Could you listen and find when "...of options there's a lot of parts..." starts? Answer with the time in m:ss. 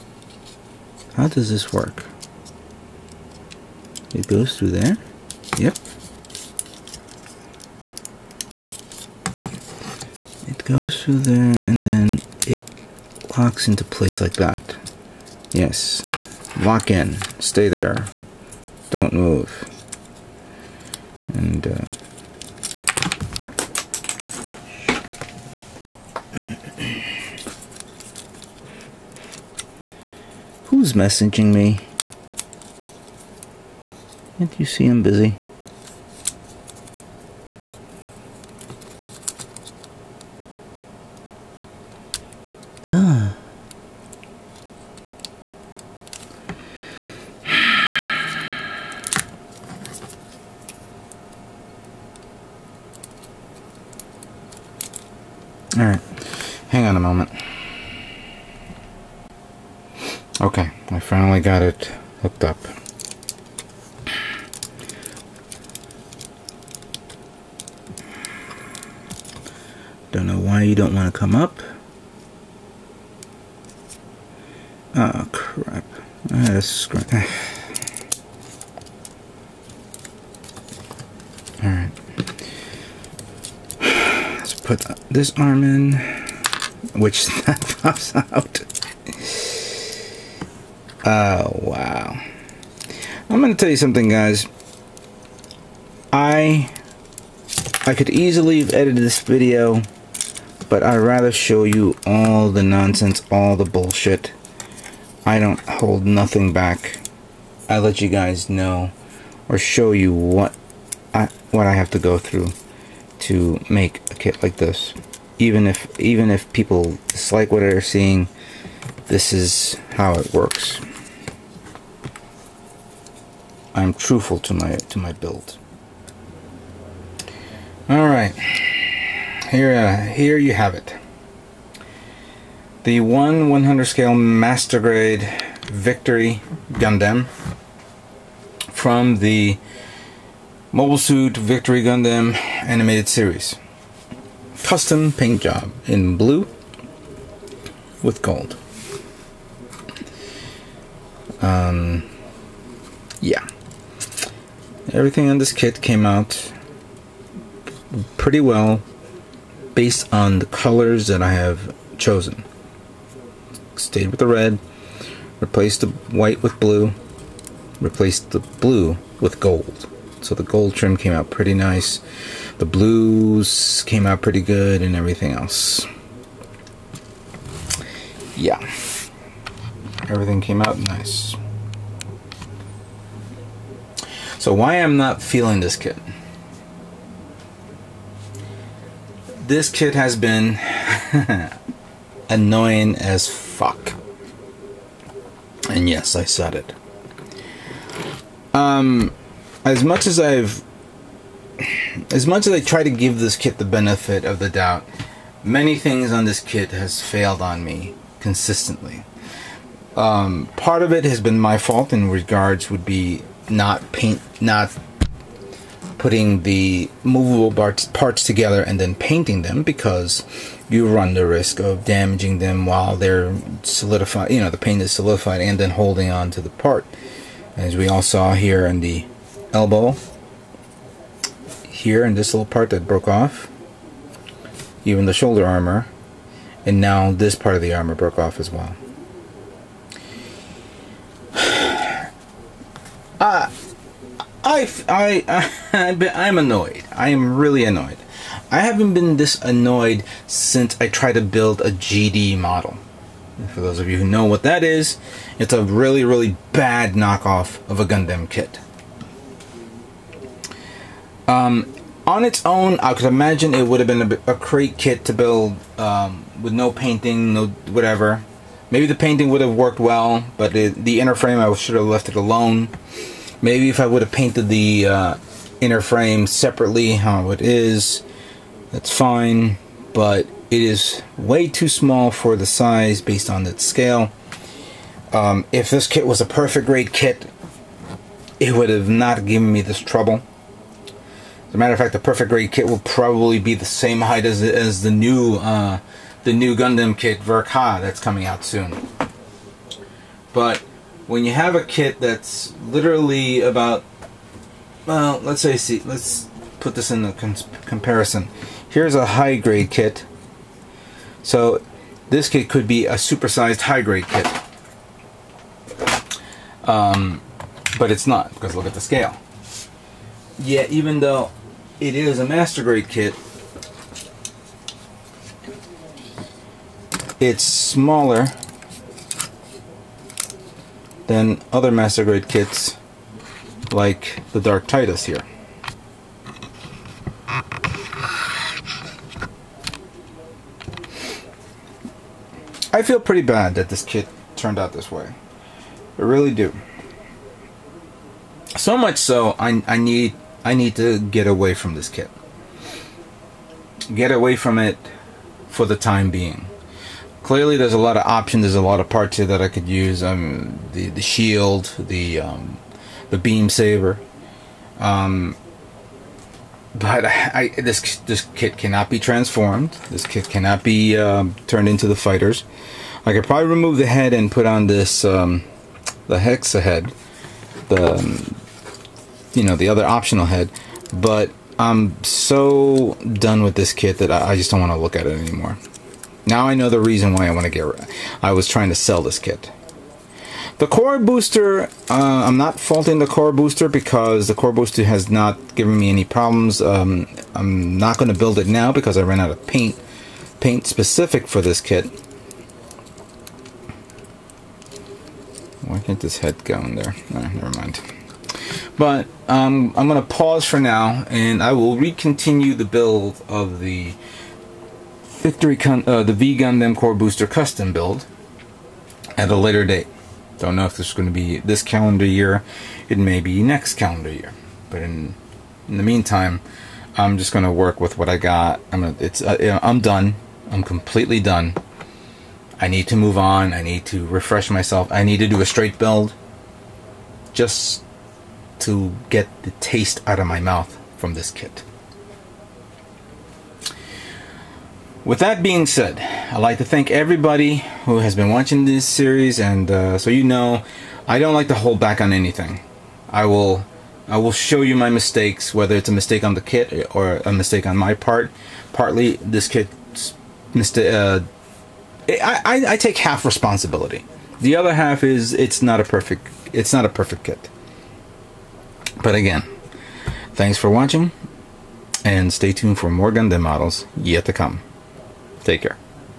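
5:57.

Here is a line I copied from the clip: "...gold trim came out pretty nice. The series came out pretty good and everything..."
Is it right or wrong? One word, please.
wrong.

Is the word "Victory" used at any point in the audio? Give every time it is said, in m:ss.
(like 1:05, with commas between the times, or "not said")
2:15, 2:21, 6:55.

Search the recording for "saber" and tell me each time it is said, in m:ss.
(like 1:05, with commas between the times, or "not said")
6:03.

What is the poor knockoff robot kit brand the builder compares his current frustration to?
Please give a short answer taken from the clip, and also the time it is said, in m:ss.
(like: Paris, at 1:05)
GD model, at 4:11.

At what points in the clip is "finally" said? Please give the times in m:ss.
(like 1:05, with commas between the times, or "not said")
1:00.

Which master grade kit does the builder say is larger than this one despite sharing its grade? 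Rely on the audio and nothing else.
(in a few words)
Dark Titus.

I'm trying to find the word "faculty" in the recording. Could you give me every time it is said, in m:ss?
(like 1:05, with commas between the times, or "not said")
not said.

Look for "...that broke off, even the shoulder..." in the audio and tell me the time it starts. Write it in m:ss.
3:52.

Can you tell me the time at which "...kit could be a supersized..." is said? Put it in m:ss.
5:12.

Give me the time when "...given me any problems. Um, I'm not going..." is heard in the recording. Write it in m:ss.
6:35.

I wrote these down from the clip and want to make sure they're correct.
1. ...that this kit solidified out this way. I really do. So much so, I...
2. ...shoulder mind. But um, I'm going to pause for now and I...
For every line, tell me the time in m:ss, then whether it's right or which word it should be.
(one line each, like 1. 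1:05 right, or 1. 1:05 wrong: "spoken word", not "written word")
1. 5:43 wrong: "turned", not "solidified"
2. 6:47 wrong: "never", not "shoulder".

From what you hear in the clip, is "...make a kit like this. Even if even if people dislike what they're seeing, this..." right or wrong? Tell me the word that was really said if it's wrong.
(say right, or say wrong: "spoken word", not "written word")
right.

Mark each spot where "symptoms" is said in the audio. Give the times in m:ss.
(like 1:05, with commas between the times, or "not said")
not said.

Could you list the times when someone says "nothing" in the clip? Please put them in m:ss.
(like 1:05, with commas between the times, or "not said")
1:46.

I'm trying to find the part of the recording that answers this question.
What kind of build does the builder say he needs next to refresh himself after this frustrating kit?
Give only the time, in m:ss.
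7:15.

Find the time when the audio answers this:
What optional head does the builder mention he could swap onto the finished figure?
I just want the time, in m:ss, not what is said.
6:16.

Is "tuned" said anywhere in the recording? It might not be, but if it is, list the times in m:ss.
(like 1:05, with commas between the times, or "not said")
7:52.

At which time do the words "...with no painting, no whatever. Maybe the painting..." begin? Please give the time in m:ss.
4:26.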